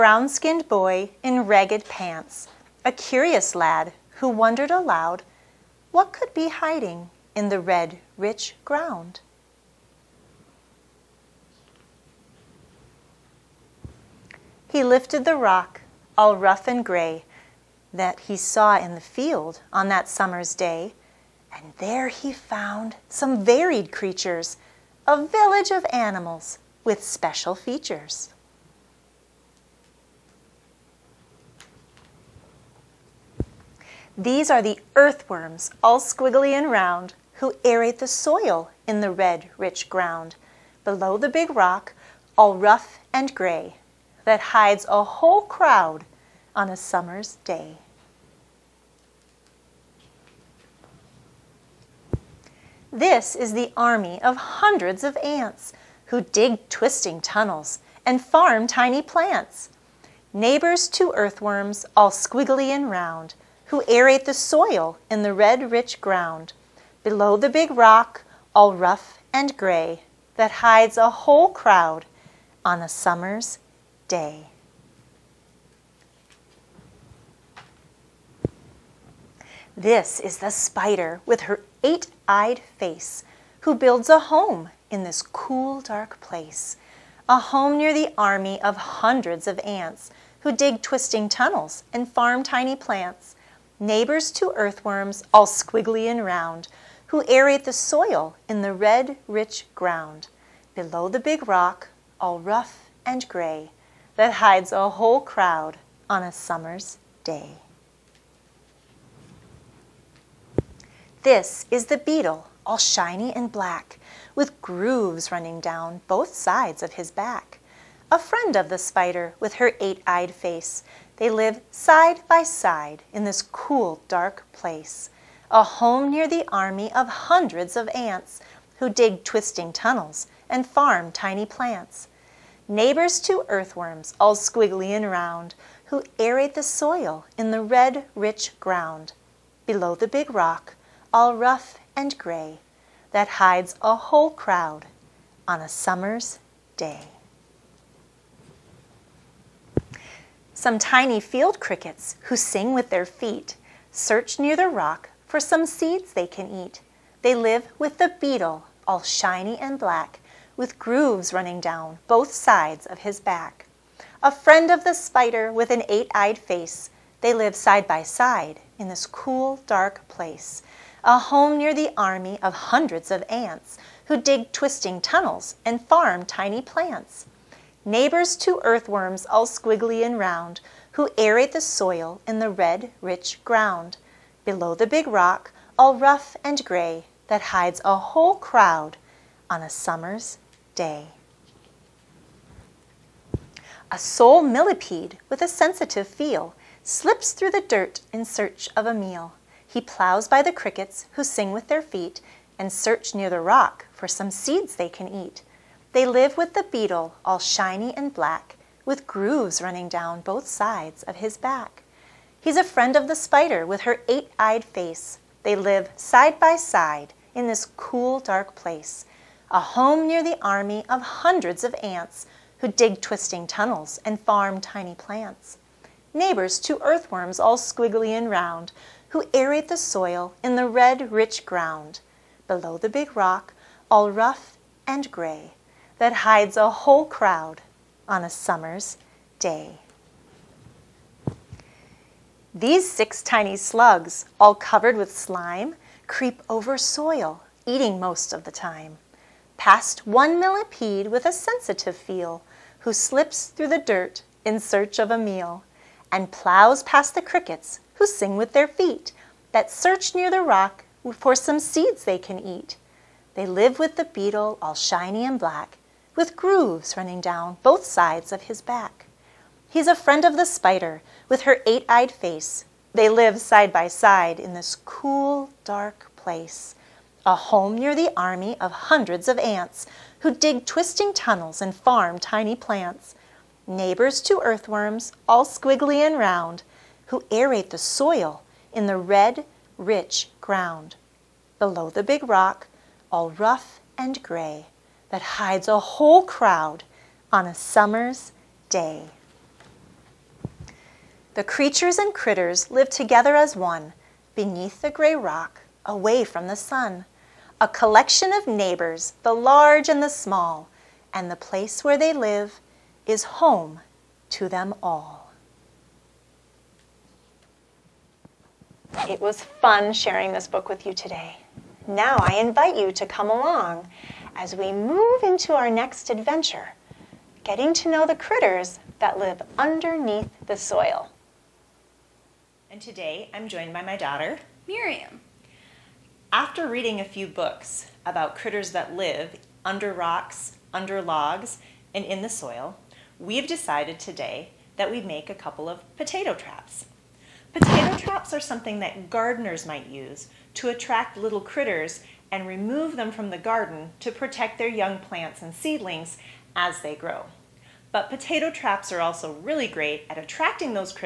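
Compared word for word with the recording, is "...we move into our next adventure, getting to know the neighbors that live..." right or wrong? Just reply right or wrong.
wrong.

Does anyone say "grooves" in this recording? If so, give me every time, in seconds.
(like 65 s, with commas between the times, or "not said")
114 s, 160 s, 209 s, 266 s.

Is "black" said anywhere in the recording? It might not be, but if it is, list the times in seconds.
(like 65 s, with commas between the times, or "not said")
113 s, 159 s, 208 s, 265 s.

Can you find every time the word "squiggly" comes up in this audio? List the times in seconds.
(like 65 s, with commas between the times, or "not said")
36 s, 62 s, 95 s, 134 s, 179 s, 227 s, 285 s.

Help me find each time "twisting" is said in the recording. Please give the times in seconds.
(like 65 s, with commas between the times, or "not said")
56 s, 90 s, 129 s, 174 s, 223 s, 280 s.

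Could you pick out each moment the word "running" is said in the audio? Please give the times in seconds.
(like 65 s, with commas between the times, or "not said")
115 s, 161 s, 209 s, 266 s.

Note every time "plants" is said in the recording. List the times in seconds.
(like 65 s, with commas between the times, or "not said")
59 s, 92 s, 131 s, 176 s, 224 s, 282 s, 355 s.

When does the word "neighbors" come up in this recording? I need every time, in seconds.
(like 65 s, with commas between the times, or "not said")
60 s, 93 s, 132 s, 177 s, 226 s, 283 s, 308 s.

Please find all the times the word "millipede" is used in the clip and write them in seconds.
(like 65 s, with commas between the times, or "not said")
194 s, 250 s.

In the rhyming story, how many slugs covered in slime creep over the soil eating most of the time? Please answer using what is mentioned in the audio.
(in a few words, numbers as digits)
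6.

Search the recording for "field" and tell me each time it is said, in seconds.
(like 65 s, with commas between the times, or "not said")
19 s, 151 s.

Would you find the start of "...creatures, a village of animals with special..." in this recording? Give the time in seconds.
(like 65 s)
23 s.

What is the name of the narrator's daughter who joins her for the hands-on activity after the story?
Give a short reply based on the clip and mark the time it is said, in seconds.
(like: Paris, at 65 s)
Miriam, at 334 s.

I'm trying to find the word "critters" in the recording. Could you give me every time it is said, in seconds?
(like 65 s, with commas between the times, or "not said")
302 s, 328 s, 338 s, 351 s.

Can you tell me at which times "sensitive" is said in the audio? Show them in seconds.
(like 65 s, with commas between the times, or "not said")
195 s, 251 s.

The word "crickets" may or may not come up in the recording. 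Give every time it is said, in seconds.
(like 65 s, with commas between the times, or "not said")
151 s, 200 s, 257 s.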